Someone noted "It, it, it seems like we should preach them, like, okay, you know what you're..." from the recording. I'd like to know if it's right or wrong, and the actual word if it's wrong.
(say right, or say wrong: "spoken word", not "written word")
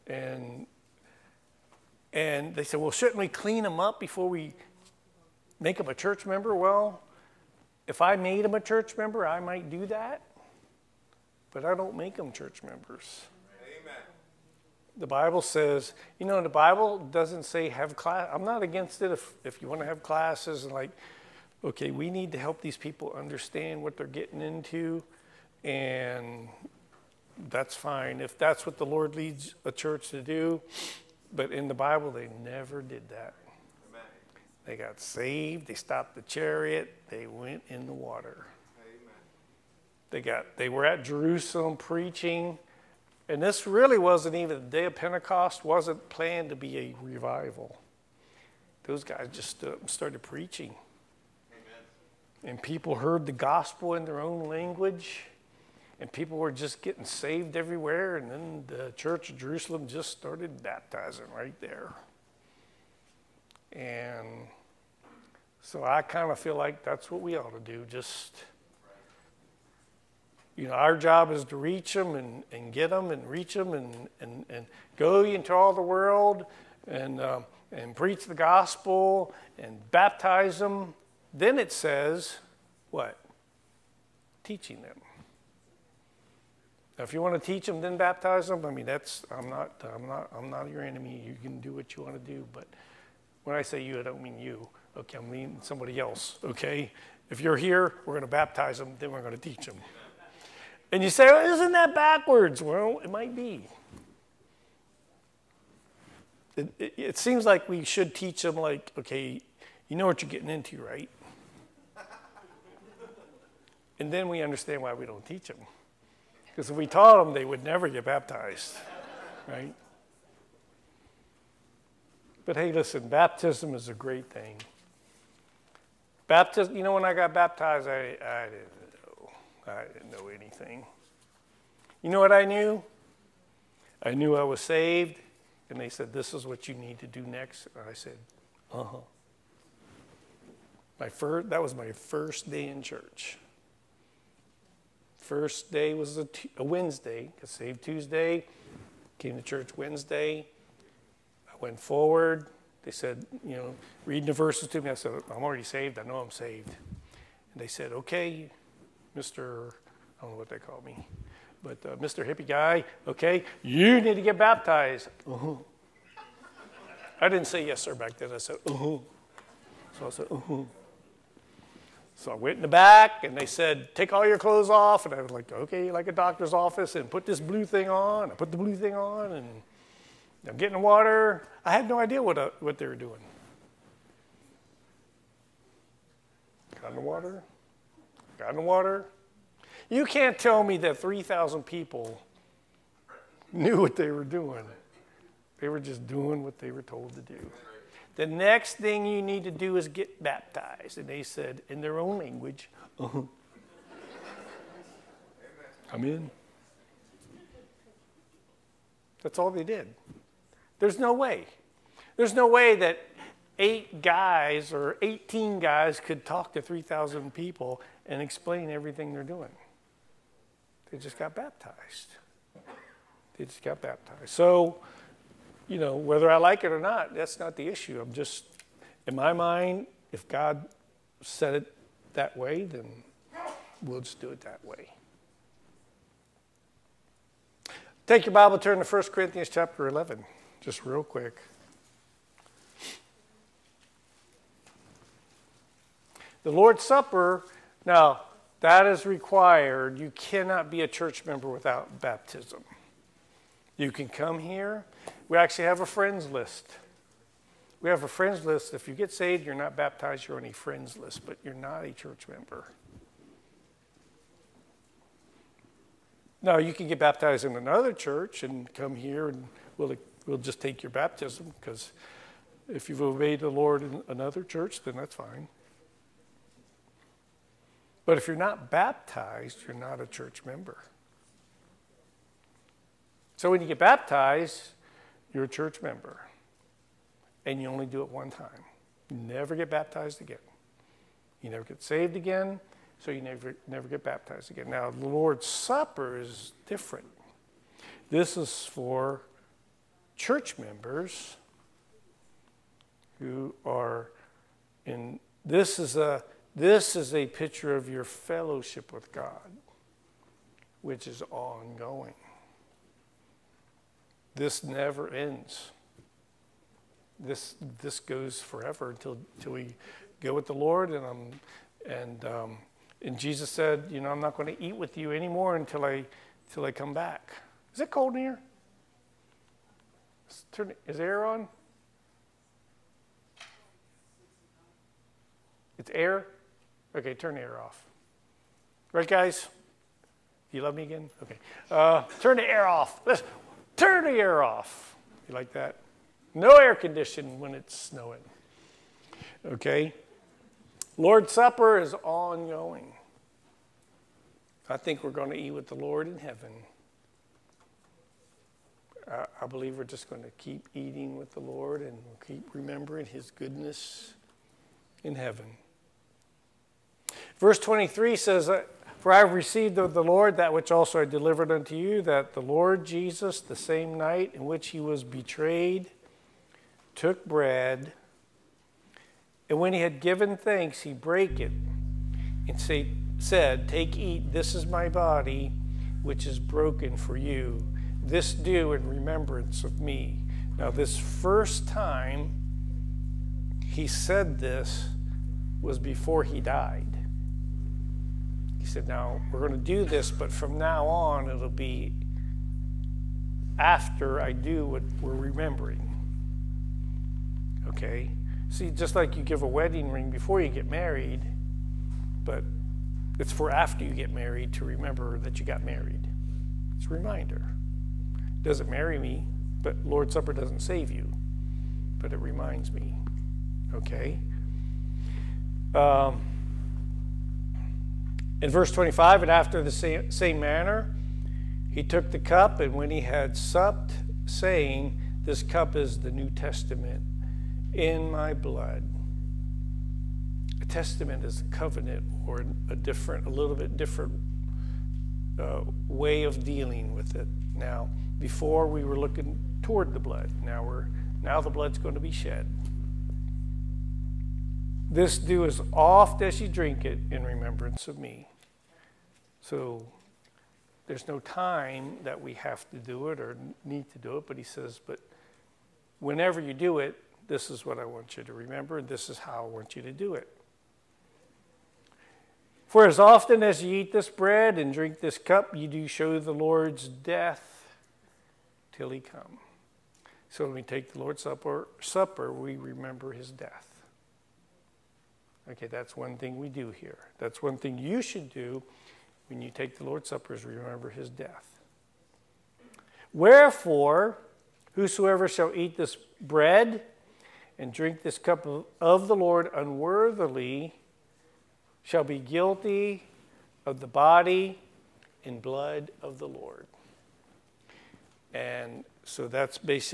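wrong: "teach", not "preach".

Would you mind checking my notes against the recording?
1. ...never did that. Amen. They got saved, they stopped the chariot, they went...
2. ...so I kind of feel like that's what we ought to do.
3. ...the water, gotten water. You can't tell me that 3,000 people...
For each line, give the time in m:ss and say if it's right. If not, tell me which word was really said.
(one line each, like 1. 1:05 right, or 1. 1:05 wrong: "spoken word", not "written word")
1. 0:32 right
2. 1:05 right
3. 3:06 right.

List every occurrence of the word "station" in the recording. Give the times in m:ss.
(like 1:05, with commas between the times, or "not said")
not said.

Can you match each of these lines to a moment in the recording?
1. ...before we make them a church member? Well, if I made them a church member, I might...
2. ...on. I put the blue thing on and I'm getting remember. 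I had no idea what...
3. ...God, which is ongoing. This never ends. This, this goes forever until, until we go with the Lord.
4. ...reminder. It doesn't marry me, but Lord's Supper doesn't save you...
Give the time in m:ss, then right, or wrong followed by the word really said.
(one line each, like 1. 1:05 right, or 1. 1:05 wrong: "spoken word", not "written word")
1. 0:03 right
2. 2:57 wrong: "water", not "remember"
3. 5:09 right
4. 6:56 right.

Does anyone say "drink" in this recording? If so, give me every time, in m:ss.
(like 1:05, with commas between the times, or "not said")
7:36, 7:54, 8:17.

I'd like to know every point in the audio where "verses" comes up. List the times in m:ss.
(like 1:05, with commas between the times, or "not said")
2:34, 6:07, 7:08.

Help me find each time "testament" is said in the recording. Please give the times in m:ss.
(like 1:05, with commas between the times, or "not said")
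7:16, 7:20.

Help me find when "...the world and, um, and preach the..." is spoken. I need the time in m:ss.
1:15.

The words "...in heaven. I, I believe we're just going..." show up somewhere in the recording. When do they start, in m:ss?
5:56.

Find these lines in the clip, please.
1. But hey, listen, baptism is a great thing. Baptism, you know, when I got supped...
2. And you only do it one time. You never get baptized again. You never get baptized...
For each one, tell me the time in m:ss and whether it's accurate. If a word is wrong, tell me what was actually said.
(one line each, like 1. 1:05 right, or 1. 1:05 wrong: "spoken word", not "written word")
1. 2:02 wrong: "baptized", not "supped"
2. 4:47 wrong: "saved", not "baptized".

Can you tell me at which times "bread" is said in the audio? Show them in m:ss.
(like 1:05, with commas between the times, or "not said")
6:17, 7:54, 8:16.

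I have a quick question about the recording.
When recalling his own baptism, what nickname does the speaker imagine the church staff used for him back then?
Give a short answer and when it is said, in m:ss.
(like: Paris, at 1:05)
Mr. Hippie Guy, at 2:41.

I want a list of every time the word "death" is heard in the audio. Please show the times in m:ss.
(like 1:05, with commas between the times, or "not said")
7:56, 8:03, 8:11.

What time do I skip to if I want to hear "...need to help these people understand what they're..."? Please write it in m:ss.
0:22.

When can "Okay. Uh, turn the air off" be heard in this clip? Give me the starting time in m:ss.
5:41.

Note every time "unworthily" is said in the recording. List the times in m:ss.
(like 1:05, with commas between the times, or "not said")
8:19.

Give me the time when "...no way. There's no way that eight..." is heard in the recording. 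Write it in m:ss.
3:30.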